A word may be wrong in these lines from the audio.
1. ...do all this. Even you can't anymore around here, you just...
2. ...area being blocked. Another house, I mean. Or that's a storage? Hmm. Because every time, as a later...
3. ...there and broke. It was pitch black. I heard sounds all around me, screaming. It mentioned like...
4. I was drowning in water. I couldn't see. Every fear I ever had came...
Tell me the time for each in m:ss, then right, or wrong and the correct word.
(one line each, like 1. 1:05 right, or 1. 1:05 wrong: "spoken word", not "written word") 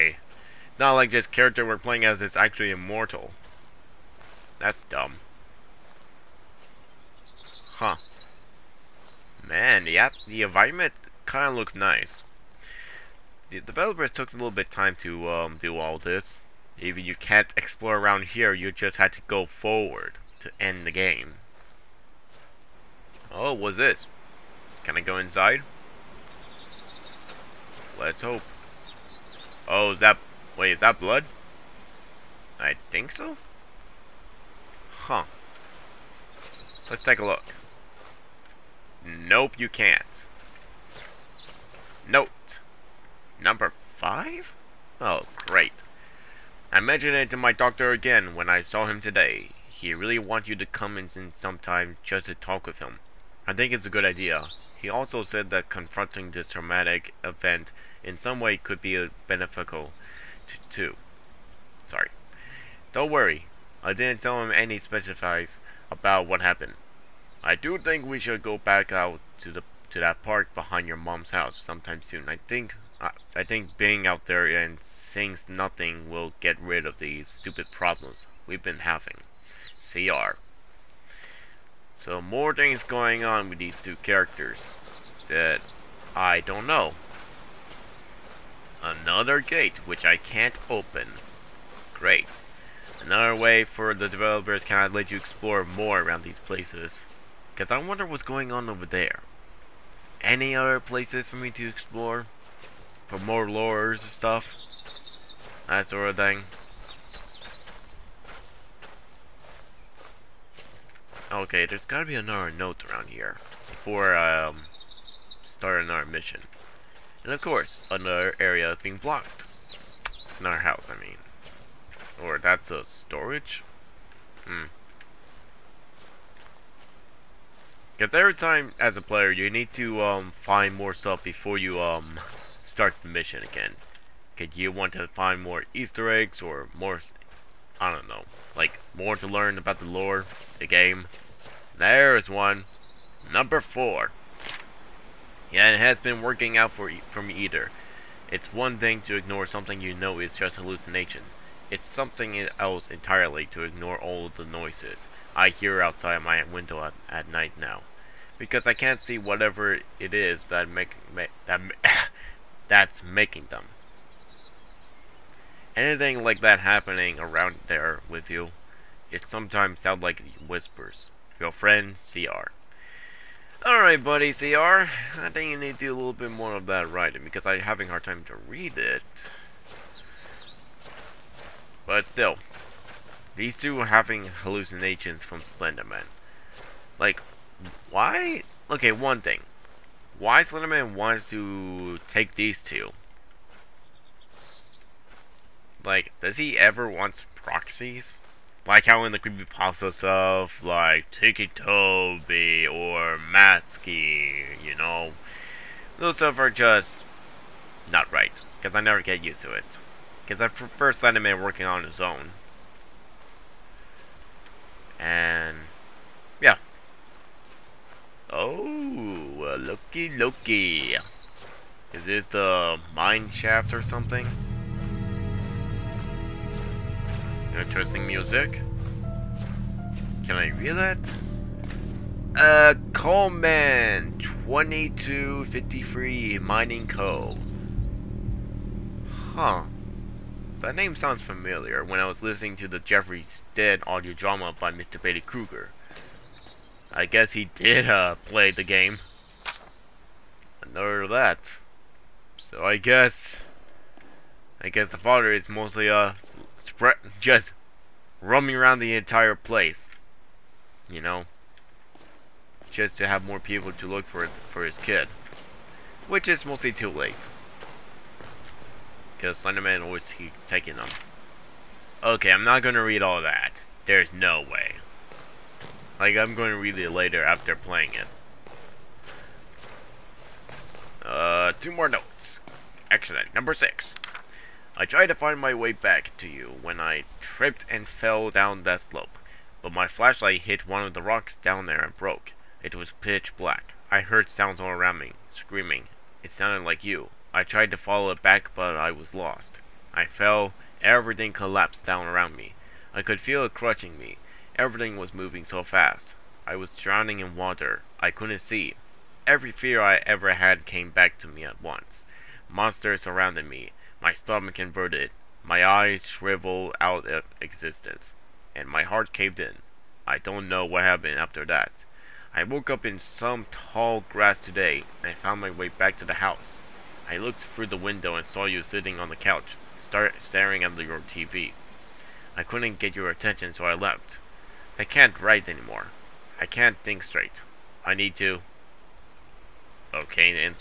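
1. 0:15 wrong: "explore", not "anymore"
2. 1:58 wrong: "player", not "later"
3. 4:51 wrong: "sounded", not "mentioned"
4. 5:06 right.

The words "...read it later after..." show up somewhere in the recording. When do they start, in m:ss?
4:36.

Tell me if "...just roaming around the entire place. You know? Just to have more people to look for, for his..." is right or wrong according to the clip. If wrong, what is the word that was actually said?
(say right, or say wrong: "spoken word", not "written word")
right.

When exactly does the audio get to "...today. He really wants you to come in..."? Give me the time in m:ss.
0:49.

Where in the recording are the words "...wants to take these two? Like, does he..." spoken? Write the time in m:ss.
3:10.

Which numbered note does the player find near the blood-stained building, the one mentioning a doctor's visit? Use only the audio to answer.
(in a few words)
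5.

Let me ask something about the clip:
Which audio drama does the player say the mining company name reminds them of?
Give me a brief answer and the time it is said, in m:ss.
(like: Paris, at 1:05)
Jeffrey's Dead, at 4:02.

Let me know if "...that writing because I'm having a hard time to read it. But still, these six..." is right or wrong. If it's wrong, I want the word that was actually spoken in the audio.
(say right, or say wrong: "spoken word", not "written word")
wrong: "two", not "six".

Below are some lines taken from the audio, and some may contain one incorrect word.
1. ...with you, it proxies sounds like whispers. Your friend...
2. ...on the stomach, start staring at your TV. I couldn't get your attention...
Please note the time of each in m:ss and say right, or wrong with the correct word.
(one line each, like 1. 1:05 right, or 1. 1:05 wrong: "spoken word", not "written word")
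1. 2:48 wrong: "sometimes", not "proxies"
2. 5:28 wrong: "couch", not "stomach".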